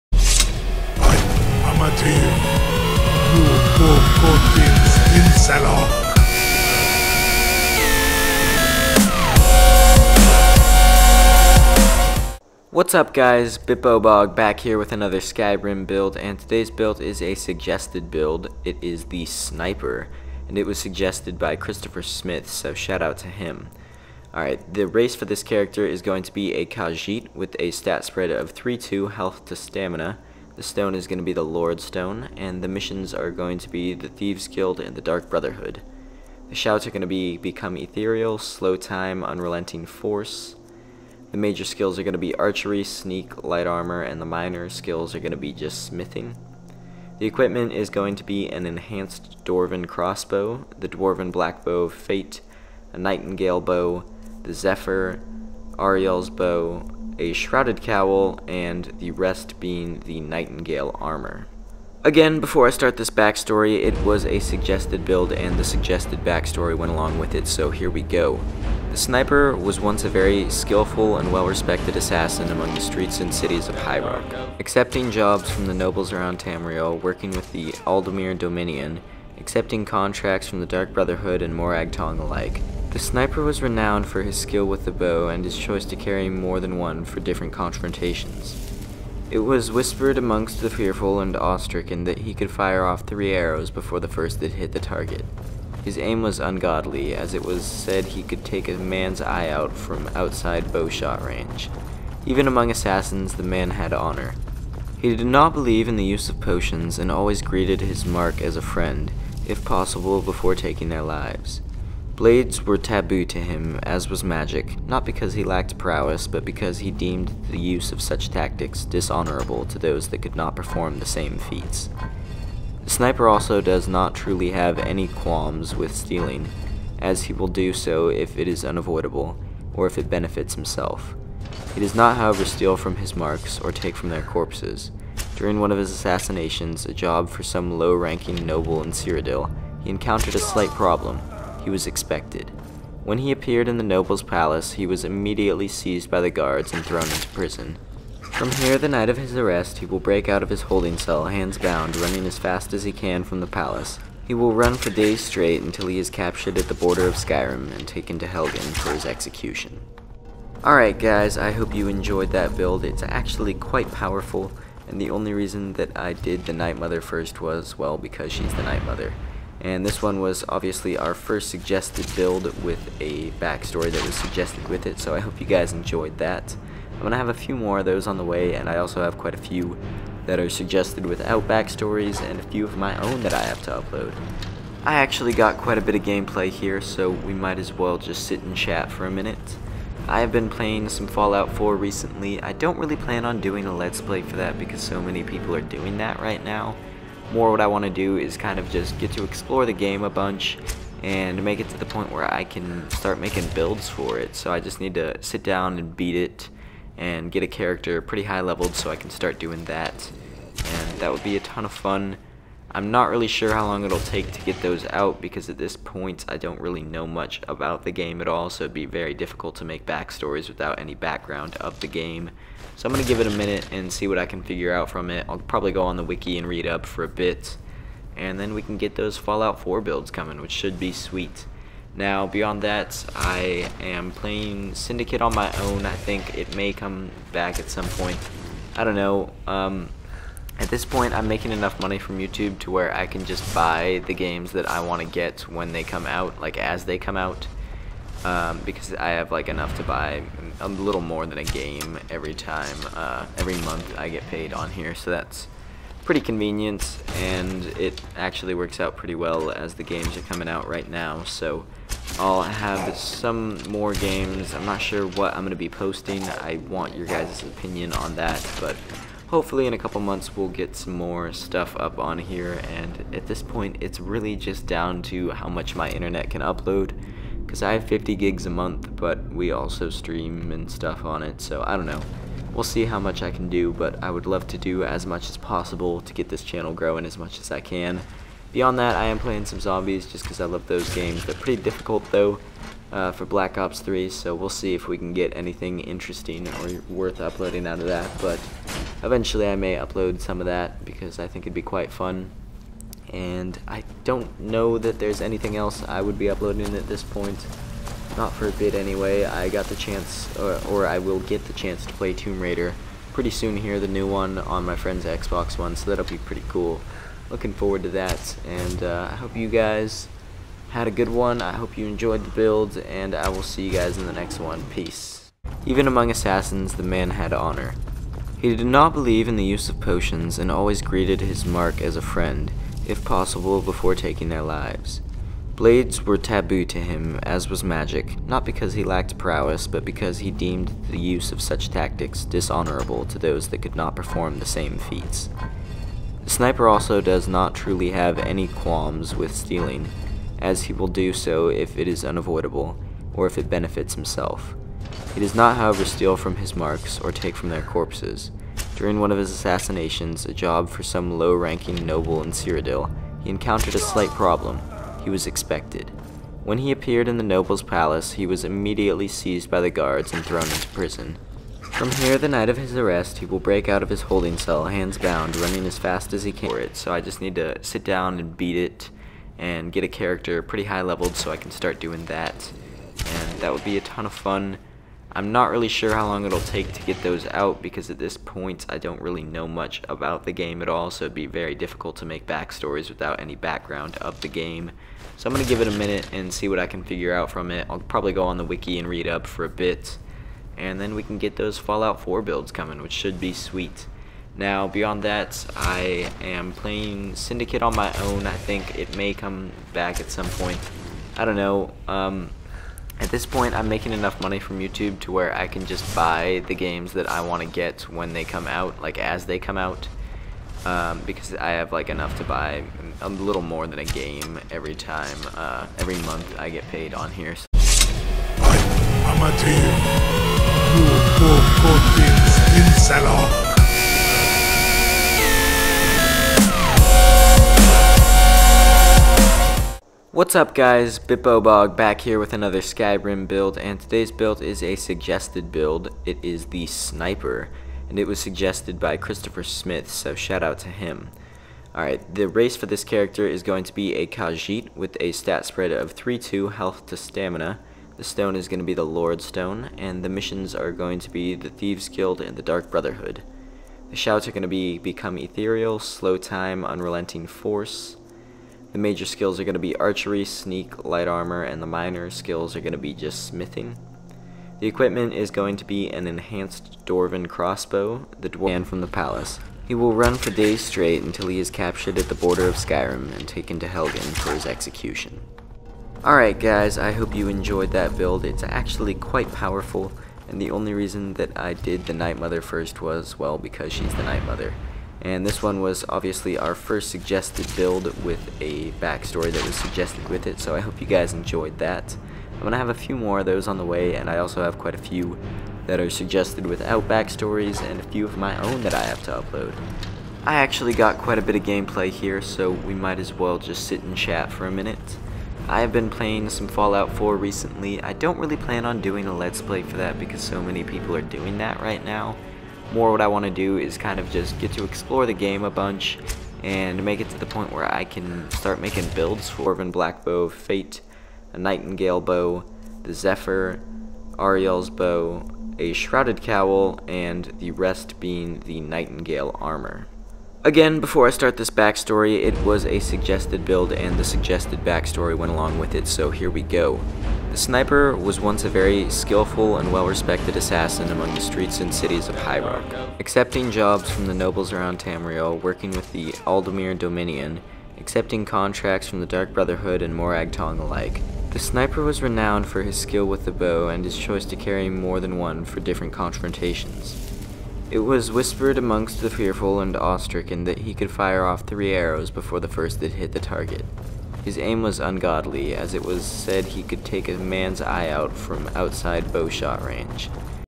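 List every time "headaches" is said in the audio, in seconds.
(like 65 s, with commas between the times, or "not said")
not said.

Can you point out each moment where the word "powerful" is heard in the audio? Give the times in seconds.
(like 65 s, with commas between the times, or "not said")
163 s, 489 s.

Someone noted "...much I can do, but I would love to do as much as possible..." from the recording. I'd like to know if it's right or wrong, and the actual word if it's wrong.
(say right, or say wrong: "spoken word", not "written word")
right.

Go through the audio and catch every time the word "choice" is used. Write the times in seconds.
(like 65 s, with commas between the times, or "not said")
85 s, 563 s.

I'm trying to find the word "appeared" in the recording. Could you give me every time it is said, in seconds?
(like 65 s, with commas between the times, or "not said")
143 s, 366 s.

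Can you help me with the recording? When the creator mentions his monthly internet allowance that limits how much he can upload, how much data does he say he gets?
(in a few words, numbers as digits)
50 gigs.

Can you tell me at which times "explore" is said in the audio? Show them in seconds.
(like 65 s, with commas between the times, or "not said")
199 s, 524 s.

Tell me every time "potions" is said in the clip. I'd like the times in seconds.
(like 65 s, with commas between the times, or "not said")
106 s, 329 s.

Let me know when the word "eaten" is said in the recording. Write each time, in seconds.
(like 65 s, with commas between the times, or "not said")
not said.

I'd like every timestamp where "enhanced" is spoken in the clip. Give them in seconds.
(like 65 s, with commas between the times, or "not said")
48 s, 476 s.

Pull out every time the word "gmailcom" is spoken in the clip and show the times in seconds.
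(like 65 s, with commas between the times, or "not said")
not said.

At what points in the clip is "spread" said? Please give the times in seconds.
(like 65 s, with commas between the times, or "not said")
28 s, 455 s.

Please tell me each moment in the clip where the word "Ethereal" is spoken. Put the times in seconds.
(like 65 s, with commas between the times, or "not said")
37 s, 465 s.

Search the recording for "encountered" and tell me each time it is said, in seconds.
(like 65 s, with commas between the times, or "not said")
139 s, 363 s.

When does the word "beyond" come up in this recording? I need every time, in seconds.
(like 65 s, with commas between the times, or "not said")
232 s, 288 s, 404 s.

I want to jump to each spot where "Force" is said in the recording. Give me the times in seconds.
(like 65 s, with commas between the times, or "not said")
39 s, 467 s.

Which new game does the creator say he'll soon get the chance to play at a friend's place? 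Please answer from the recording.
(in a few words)
Tomb Raider.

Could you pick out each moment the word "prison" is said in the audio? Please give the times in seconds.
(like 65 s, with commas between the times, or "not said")
147 s, 370 s.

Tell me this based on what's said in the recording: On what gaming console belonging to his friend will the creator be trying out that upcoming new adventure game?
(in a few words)
Xbox One.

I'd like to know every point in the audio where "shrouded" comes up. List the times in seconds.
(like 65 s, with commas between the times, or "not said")
57 s, 535 s.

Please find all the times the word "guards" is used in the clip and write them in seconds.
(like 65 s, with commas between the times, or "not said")
146 s, 369 s.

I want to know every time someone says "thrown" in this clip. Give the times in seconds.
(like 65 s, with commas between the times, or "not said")
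146 s, 370 s.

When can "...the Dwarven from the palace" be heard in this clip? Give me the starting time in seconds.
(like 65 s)
478 s.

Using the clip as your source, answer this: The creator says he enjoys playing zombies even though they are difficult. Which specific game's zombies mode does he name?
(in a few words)
Black Ops 3.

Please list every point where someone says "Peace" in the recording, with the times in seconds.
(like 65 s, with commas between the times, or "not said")
324 s.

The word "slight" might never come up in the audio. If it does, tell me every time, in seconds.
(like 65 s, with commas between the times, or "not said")
140 s, 363 s.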